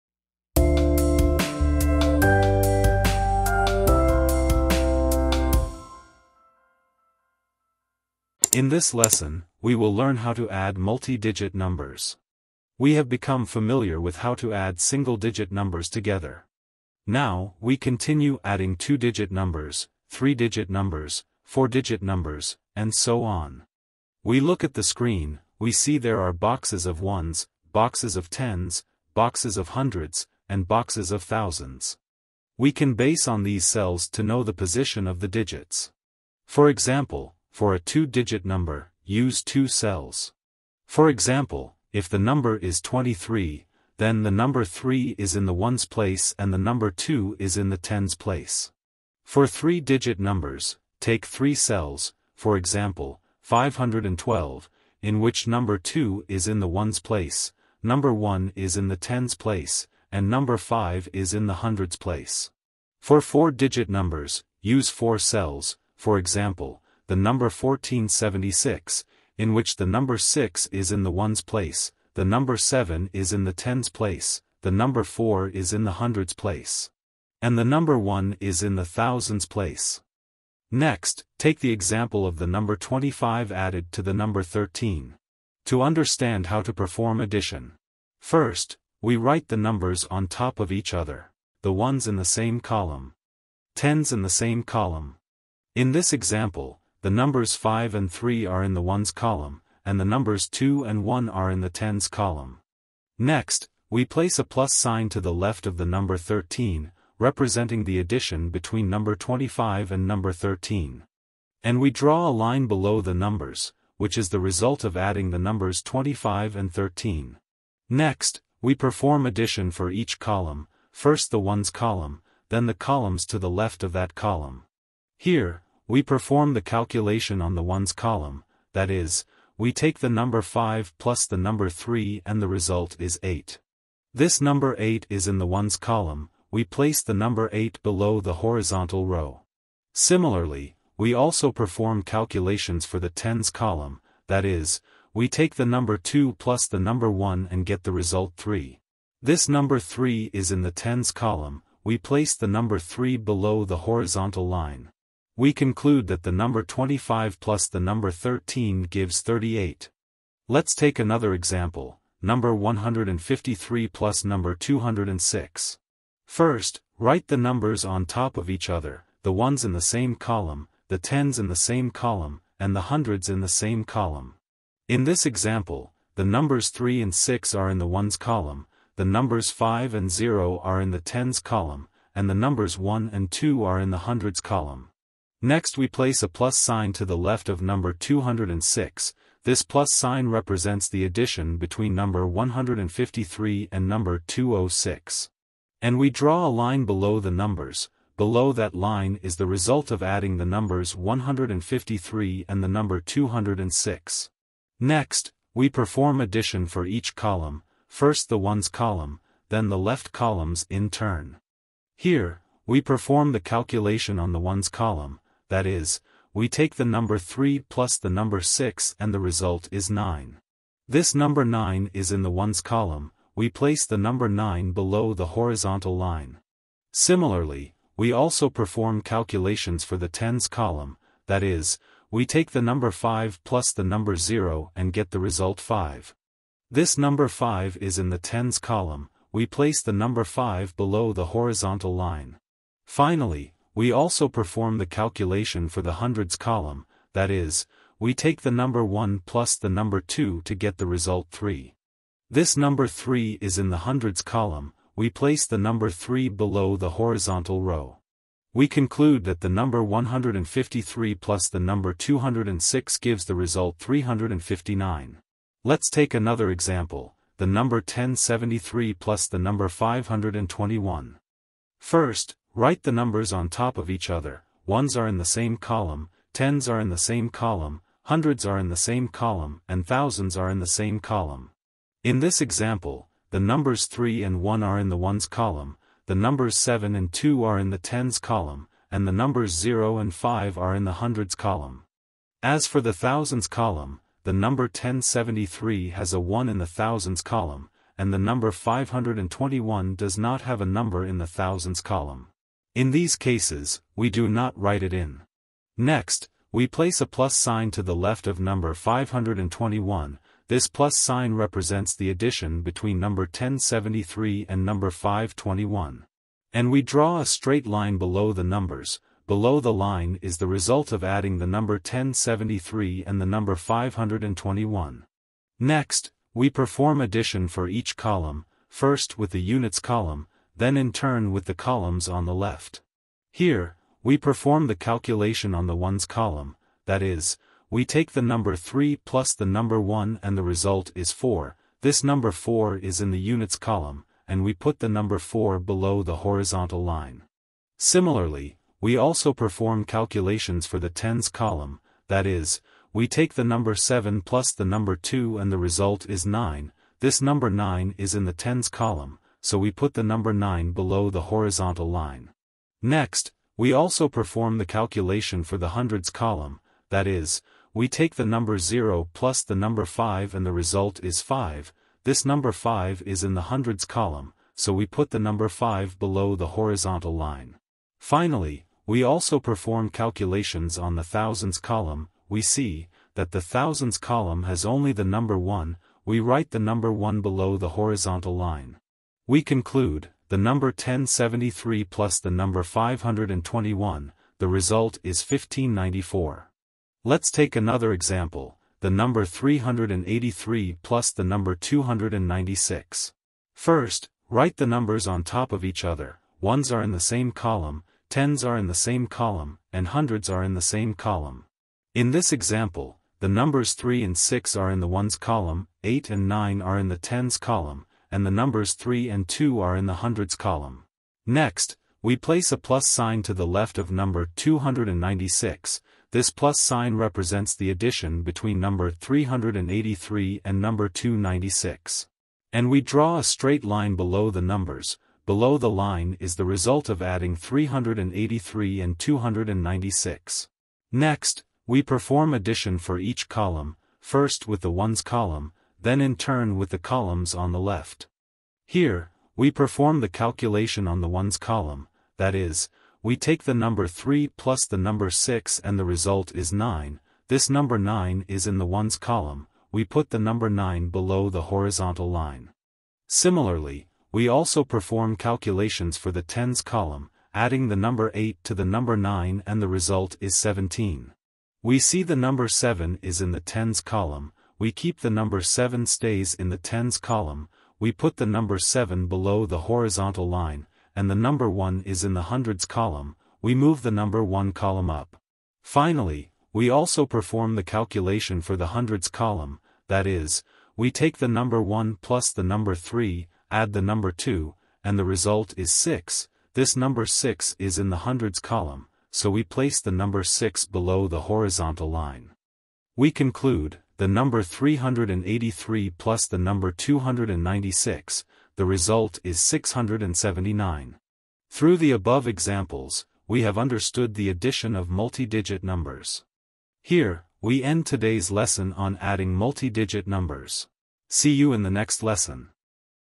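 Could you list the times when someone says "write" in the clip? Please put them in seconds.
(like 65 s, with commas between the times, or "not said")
89 s, 166 s, 272 s, 304 s, 386 s, 404 s.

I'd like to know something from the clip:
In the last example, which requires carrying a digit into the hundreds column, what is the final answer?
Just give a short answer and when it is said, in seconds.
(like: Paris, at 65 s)
679, at 509 s.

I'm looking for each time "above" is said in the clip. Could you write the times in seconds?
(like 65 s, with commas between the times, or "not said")
511 s.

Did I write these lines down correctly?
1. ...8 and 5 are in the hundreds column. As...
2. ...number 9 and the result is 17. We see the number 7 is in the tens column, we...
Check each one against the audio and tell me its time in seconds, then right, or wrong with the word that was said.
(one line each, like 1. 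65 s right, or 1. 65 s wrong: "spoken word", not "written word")
1. 289 s wrong: "0", not "8"
2. 468 s right.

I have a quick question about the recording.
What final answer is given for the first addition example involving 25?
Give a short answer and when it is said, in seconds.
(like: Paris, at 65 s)
38, at 159 s.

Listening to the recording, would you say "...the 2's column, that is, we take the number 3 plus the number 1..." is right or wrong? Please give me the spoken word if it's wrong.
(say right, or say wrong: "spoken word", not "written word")
wrong: "1", not "2".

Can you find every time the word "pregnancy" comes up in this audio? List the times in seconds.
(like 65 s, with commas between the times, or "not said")
not said.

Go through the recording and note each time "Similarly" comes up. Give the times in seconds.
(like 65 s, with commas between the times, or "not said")
139 s, 226 s, 347 s, 463 s.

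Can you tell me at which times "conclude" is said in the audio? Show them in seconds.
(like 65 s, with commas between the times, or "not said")
155 s, 258 s, 389 s, 503 s.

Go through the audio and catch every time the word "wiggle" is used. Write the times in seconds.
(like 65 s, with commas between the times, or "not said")
not said.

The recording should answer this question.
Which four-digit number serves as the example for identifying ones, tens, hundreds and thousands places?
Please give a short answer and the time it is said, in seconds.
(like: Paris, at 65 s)
1476, at 67 s.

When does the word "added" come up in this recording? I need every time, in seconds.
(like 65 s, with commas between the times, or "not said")
83 s.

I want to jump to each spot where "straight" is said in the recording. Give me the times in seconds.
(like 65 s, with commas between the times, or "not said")
317 s, 433 s.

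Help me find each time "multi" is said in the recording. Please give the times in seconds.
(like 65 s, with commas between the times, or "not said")
10 s, 514 s, 519 s.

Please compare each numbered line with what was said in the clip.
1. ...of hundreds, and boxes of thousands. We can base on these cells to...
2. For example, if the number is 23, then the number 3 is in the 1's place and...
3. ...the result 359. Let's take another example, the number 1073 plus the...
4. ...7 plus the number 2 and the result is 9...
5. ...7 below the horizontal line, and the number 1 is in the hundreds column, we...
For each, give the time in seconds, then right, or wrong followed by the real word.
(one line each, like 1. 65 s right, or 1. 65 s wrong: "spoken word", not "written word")
1. 29 s right
2. 40 s right
3. 263 s right
4. 353 s right
5. 478 s right.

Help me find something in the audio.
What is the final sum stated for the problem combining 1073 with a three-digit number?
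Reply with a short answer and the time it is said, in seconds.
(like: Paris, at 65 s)
1594, at 395 s.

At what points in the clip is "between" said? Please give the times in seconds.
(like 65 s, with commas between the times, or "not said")
108 s, 191 s, 312 s, 428 s.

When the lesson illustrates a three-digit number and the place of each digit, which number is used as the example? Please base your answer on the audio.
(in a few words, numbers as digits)
512.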